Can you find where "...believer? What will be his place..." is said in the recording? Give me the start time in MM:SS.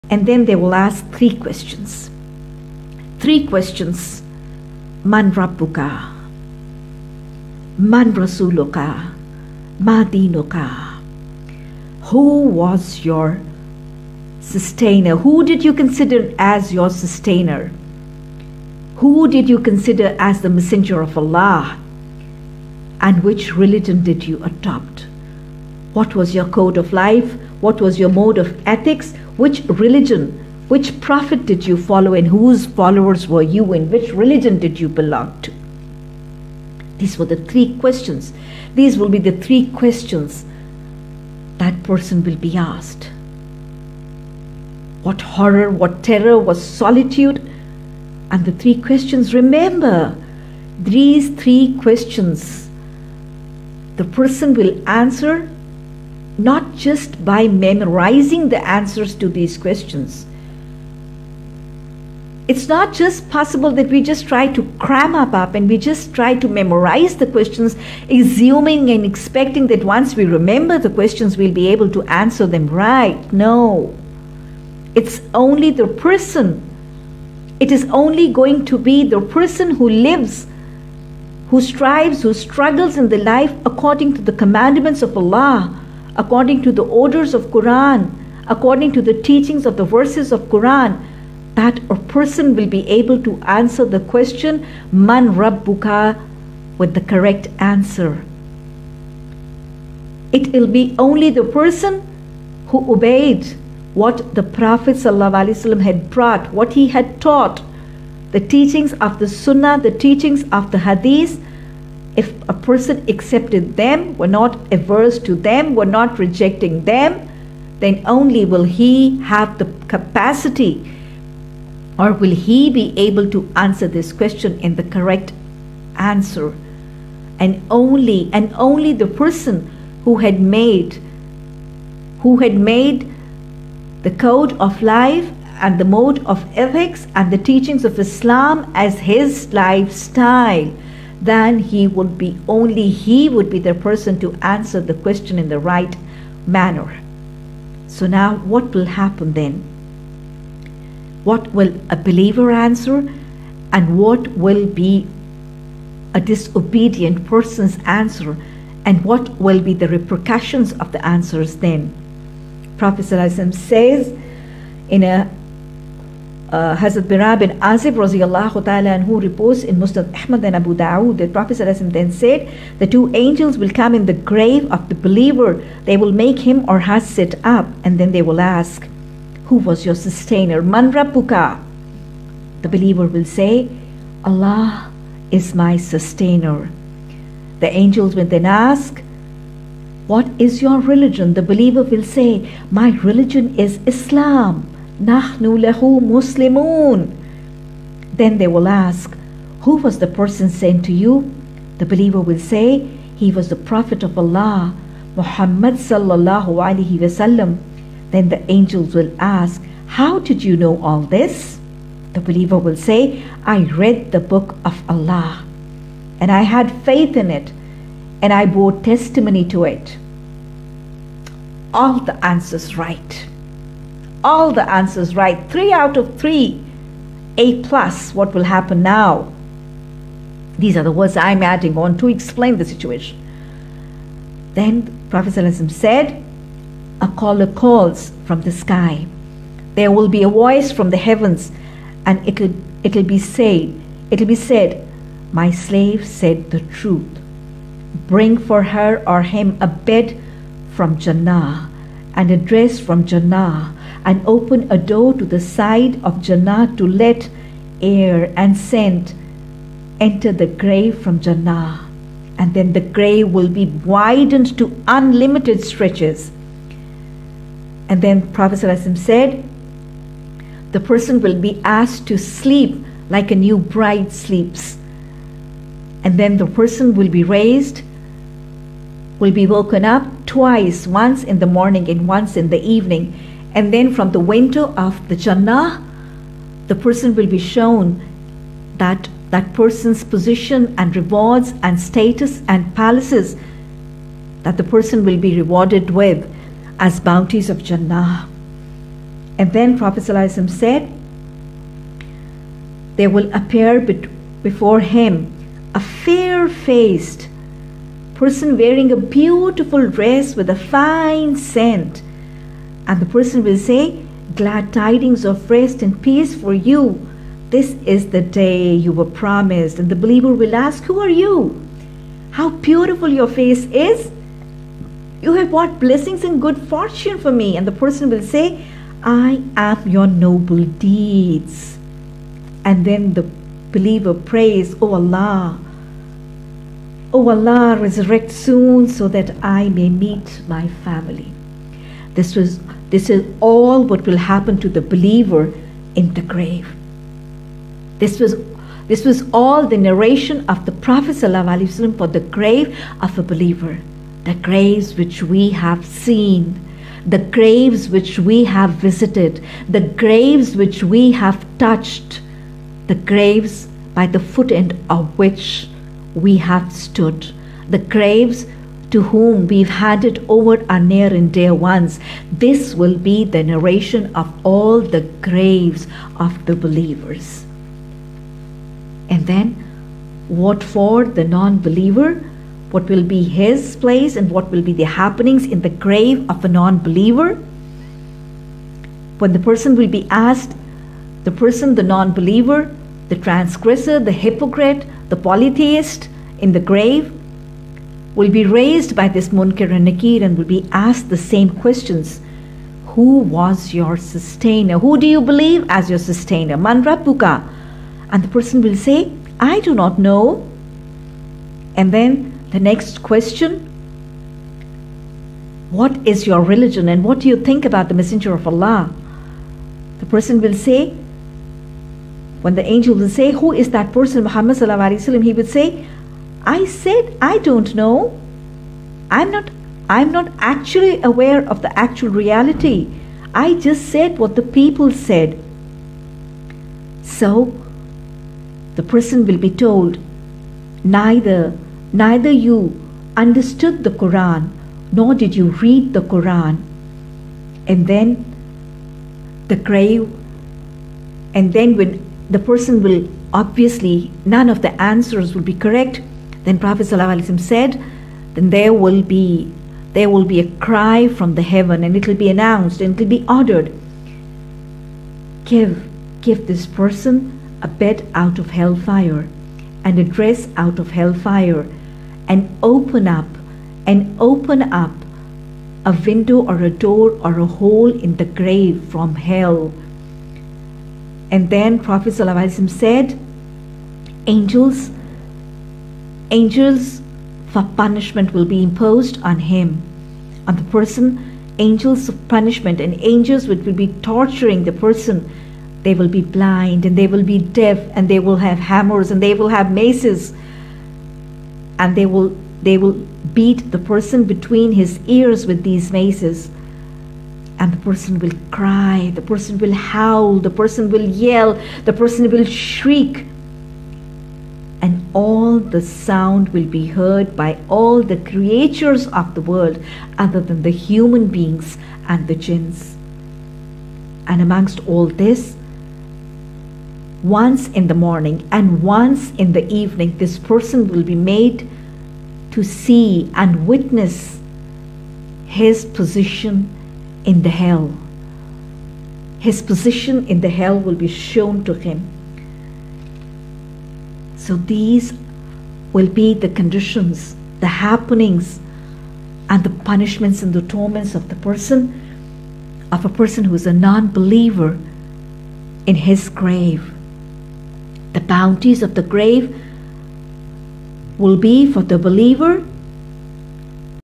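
06:21.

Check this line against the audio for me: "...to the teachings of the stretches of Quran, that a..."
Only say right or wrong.
wrong.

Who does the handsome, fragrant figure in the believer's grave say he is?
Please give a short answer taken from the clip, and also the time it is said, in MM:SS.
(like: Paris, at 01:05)
Your noble deeds, at 05:29.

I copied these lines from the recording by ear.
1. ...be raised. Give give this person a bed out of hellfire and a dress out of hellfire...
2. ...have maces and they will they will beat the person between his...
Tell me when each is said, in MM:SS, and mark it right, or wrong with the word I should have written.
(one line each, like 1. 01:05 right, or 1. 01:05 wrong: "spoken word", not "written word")
1. 07:43 wrong: "ordered", not "raised"
2. 08:19 right.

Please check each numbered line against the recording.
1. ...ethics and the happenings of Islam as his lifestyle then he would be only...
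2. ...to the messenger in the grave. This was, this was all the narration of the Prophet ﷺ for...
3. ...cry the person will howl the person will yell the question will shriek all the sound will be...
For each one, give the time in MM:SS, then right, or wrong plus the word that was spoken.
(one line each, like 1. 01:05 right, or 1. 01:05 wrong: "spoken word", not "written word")
1. 02:16 wrong: "teachings", not "happenings"
2. 05:44 wrong: "believer", not "messenger"
3. 08:28 wrong: "person", not "question".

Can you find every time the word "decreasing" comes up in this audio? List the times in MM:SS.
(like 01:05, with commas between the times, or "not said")
not said.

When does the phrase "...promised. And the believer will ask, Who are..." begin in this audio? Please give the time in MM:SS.
05:19.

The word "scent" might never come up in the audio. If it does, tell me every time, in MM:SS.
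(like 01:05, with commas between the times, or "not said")
04:18, 05:11.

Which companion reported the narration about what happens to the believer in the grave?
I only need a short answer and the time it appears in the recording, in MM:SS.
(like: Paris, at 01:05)
Bara bin Azib, at 02:46.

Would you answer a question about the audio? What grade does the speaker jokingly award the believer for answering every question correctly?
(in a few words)
A plus.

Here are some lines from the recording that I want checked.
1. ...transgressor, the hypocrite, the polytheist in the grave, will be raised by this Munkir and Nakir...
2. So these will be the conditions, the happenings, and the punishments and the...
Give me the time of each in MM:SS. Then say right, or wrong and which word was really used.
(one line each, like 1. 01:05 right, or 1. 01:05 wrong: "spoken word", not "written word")
1. 06:33 right
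2. 09:04 right.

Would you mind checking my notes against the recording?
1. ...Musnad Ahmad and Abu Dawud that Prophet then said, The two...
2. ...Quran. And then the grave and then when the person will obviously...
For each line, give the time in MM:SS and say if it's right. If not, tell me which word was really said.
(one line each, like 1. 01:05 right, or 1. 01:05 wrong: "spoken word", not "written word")
1. 02:49 right
2. 07:26 right.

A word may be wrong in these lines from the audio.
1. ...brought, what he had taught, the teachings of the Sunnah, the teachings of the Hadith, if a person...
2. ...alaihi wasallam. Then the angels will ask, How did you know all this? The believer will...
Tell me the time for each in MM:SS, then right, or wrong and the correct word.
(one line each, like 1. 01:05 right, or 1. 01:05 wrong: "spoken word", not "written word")
1. 01:46 right
2. 03:26 right.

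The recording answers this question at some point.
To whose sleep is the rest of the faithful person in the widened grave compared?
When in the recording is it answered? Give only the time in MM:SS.
04:33.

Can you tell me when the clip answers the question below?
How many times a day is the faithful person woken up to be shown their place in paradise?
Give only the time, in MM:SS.
04:40.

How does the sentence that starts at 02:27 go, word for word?
So now what will happen then?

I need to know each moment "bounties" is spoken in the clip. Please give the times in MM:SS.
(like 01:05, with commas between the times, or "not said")
04:56, 09:18.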